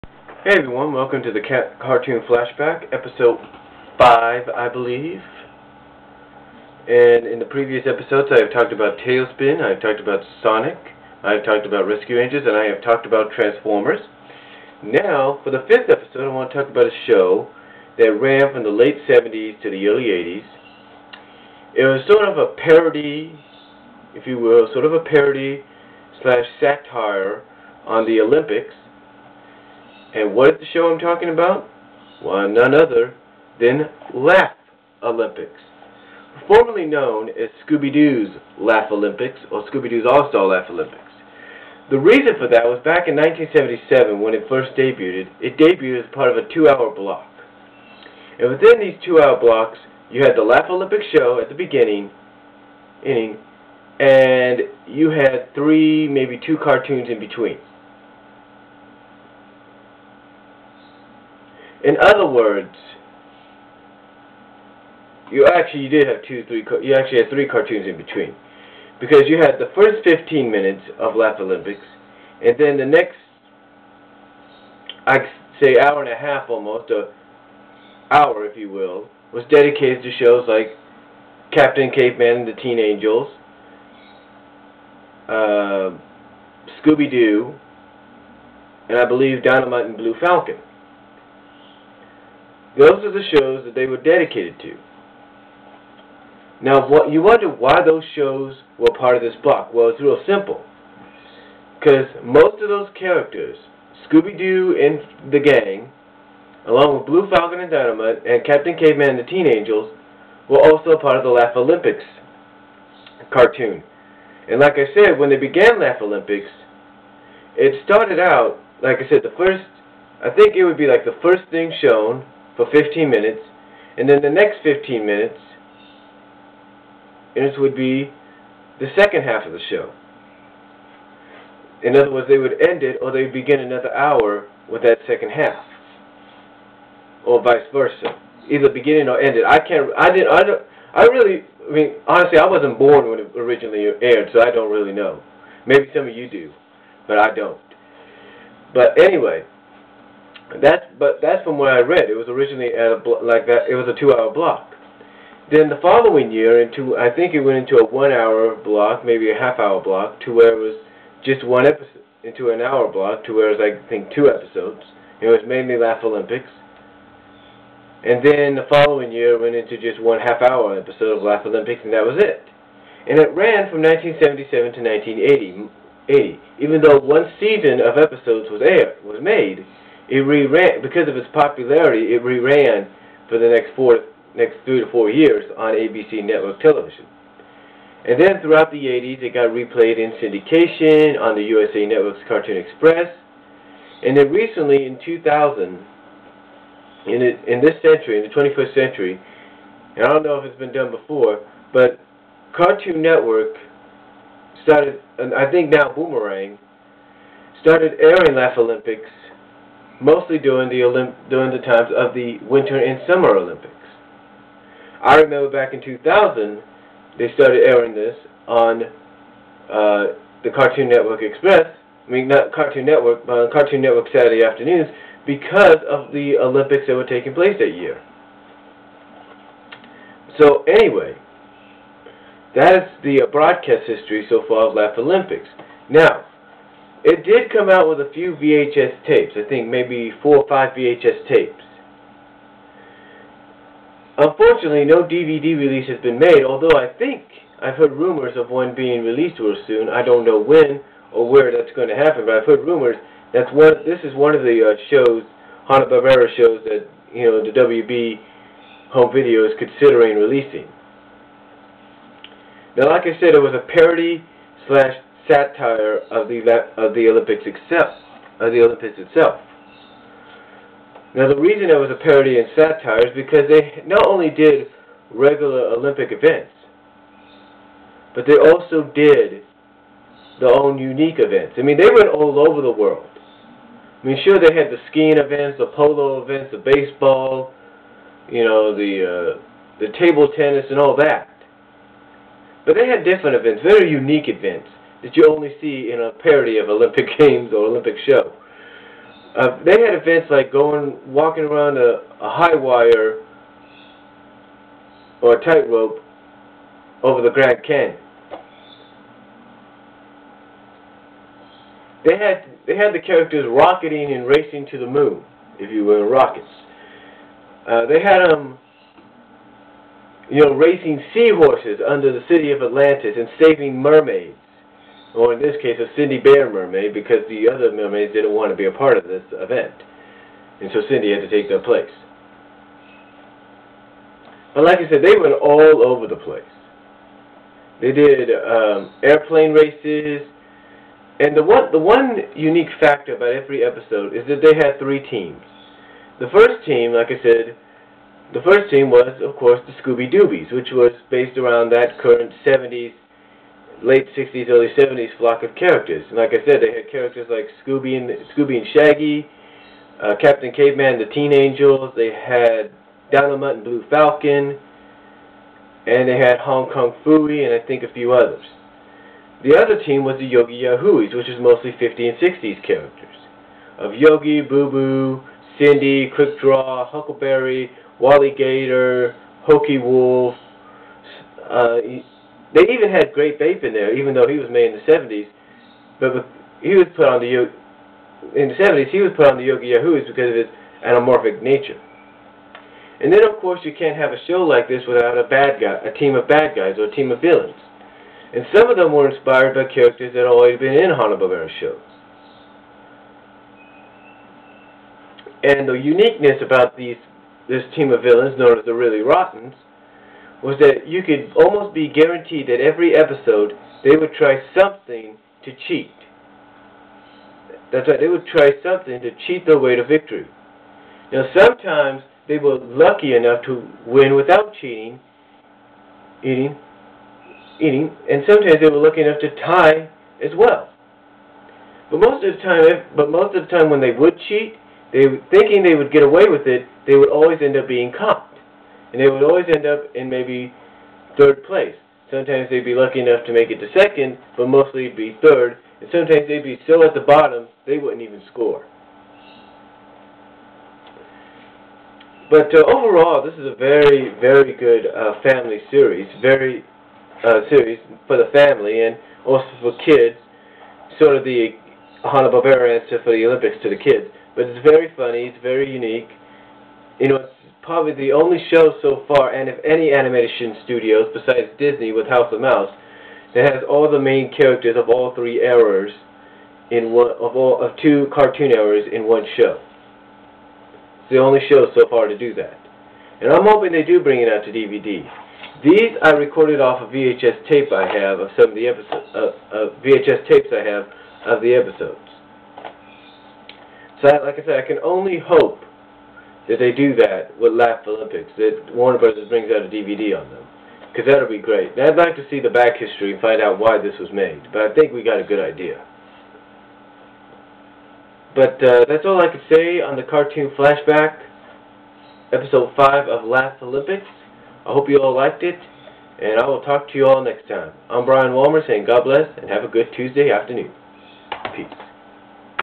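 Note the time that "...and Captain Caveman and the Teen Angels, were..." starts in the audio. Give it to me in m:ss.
1:48.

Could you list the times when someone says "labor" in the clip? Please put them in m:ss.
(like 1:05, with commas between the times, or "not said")
not said.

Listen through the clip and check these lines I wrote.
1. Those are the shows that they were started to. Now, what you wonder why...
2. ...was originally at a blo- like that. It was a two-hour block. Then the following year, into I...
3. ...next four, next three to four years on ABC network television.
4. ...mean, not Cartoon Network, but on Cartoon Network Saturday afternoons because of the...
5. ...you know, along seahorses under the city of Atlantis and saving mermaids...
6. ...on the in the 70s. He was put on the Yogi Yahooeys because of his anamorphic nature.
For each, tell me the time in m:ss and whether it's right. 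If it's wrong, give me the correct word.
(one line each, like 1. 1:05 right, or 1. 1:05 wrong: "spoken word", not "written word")
1. 1:32 wrong: "dedicated", not "started"
2. 2:32 right
3. 3:03 right
4. 3:42 right
5. 5:20 wrong: "racing", not "along"
6. 6:27 right.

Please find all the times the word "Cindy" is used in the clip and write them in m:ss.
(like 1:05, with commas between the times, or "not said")
5:25, 5:30, 6:15.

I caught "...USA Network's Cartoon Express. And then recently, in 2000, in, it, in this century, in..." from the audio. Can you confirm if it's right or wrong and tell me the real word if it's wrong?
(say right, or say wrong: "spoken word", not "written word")
right.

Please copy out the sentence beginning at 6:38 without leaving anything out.
And some of them were inspired by characters that had already been in Hanna-Barbera shows.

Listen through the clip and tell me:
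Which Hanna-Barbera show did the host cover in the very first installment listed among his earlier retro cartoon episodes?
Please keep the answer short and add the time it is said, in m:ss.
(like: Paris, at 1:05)
TaleSpin, at 0:09.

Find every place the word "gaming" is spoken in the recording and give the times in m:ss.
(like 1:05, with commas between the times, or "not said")
not said.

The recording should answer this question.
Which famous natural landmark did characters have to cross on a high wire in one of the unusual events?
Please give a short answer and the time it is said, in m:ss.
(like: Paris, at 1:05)
Grand Canyon, at 5:07.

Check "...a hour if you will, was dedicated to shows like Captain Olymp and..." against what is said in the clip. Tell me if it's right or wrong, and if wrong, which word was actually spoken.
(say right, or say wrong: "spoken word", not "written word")
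wrong: "Caveman", not "Olymp".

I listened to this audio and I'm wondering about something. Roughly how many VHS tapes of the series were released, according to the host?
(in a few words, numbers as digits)
4 or 5.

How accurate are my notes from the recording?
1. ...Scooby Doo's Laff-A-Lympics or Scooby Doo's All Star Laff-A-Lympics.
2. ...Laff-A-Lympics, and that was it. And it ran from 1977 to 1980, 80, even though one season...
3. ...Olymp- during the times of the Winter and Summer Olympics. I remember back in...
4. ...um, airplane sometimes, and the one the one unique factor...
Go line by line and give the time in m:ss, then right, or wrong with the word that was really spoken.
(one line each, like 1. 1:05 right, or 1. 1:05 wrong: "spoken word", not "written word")
1. 0:37 right
2. 2:51 right
3. 3:30 right
4. 5:38 wrong: "races", not "sometimes".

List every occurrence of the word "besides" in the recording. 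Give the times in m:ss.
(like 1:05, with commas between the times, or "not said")
7:51.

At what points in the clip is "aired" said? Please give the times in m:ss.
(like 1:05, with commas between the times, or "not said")
2:24, 2:58.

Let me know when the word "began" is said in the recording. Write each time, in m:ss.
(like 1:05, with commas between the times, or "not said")
1:55.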